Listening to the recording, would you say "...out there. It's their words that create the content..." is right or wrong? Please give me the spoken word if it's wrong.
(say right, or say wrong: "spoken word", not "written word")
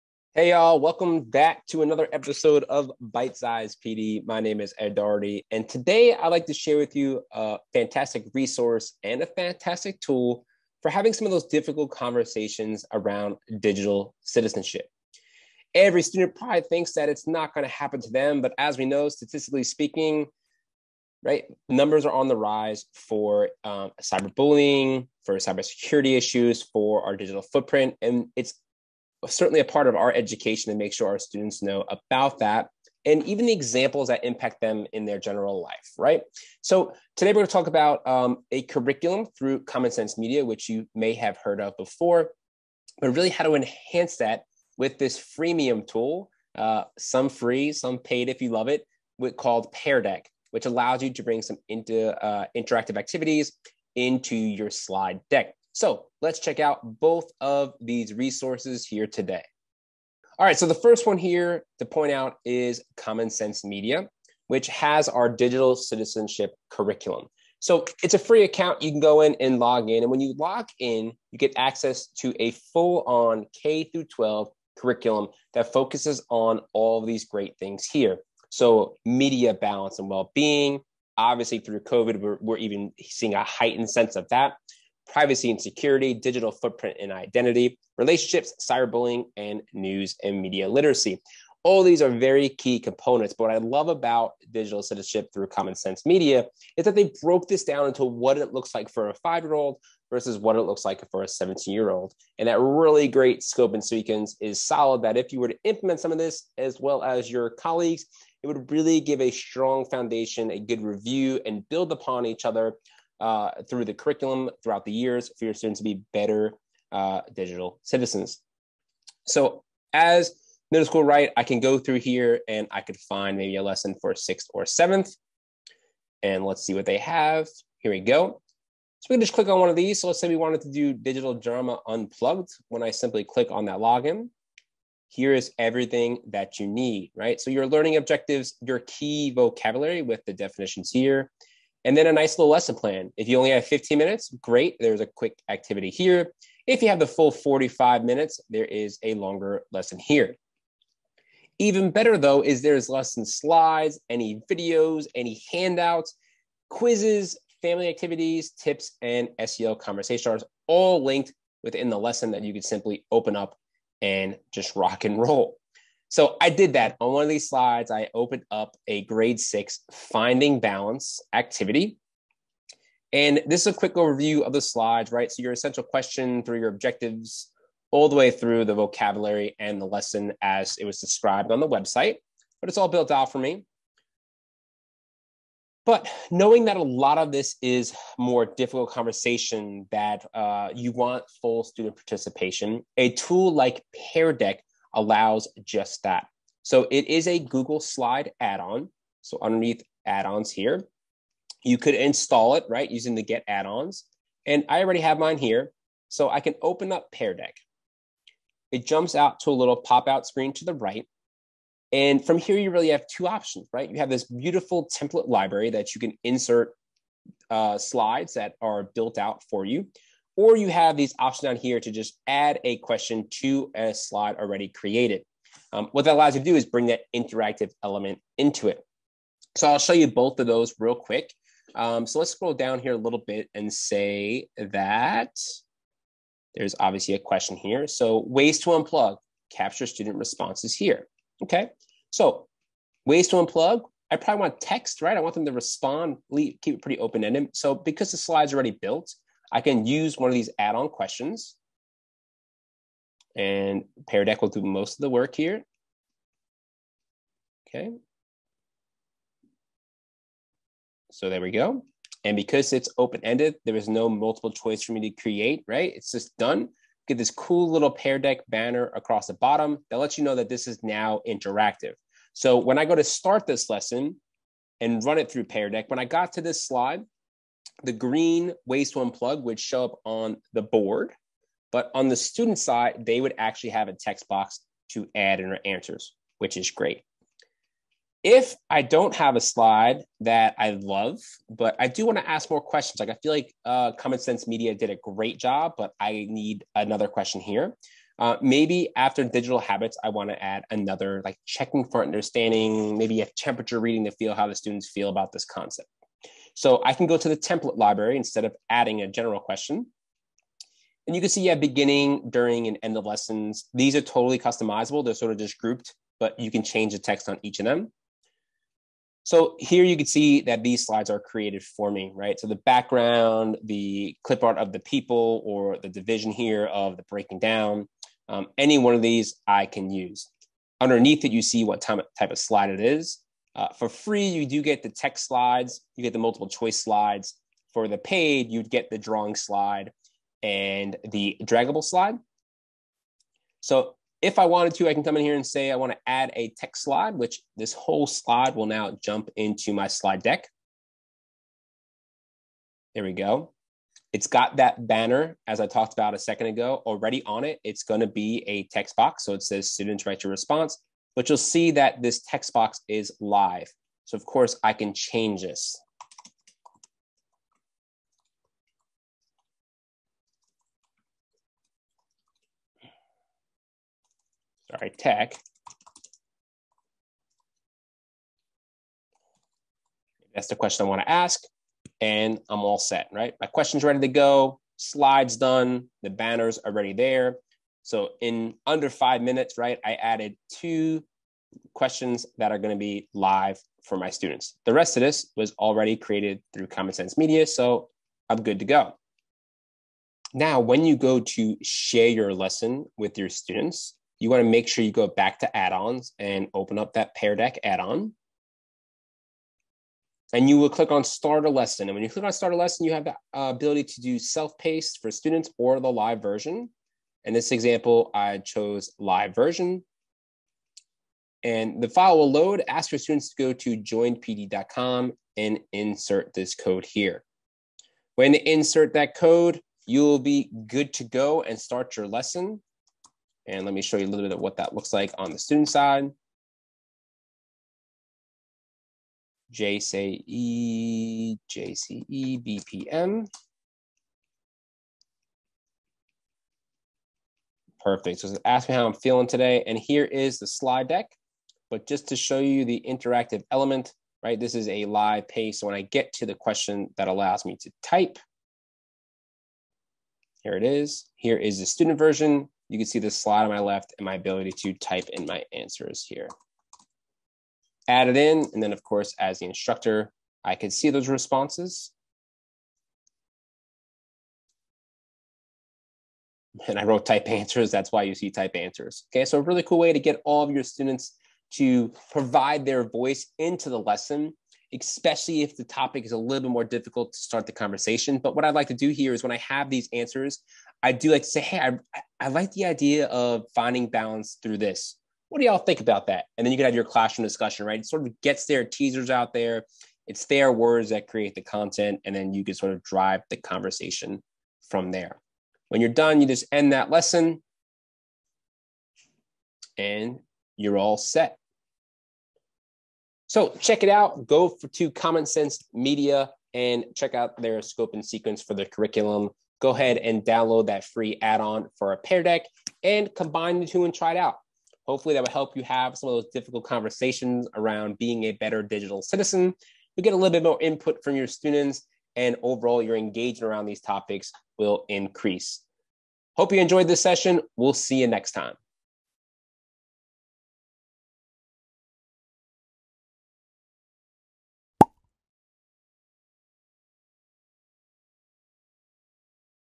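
right.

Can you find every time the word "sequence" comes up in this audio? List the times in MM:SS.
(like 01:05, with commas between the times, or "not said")
01:43, 08:38.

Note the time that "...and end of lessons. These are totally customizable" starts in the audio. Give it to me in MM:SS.
05:12.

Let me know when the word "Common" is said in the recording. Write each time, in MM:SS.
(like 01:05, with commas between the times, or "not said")
00:39, 01:02, 01:35, 04:53, 06:36, 08:34.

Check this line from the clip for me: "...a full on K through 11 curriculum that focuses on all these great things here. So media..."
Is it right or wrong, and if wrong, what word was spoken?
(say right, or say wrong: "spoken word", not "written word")
wrong: "12", not "11".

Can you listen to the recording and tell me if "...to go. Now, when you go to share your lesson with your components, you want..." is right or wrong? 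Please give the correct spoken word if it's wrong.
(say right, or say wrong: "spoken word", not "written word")
wrong: "students", not "components".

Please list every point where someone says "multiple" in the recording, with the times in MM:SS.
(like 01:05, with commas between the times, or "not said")
04:24, 05:36.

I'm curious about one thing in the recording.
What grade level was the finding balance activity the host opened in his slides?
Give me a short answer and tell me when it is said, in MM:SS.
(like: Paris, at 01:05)
grade 6, at 02:49.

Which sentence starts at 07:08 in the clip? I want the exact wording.
When you insert that code, you'll be good to go and start your lesson.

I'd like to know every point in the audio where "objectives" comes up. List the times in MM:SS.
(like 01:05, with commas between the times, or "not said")
02:17, 02:56.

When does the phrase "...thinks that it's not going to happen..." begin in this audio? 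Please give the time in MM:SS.
00:16.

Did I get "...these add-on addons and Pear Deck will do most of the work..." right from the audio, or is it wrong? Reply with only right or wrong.
wrong.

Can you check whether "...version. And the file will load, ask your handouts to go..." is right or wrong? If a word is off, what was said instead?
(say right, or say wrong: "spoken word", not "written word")
wrong: "students", not "handouts".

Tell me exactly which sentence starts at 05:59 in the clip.
So it says students write your response but you'll see that this text box is live.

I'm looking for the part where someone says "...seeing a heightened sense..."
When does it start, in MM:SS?
01:22.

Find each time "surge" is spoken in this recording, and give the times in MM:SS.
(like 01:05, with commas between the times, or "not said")
not said.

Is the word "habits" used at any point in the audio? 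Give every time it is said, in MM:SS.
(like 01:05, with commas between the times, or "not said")
04:59.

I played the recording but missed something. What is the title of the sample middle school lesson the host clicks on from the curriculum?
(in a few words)
Digital Drama Unplugged.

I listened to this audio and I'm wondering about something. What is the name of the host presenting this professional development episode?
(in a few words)
Ed Doherty.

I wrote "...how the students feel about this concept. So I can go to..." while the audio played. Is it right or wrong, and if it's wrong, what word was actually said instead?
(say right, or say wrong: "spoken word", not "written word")
right.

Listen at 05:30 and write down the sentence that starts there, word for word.
Underneath it, you see what type of slide it is.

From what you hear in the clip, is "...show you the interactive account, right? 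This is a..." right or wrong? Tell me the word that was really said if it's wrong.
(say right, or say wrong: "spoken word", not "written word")
wrong: "element", not "account".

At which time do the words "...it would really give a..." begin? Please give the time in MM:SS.
01:48.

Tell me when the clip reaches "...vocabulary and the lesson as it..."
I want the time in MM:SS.
02:58.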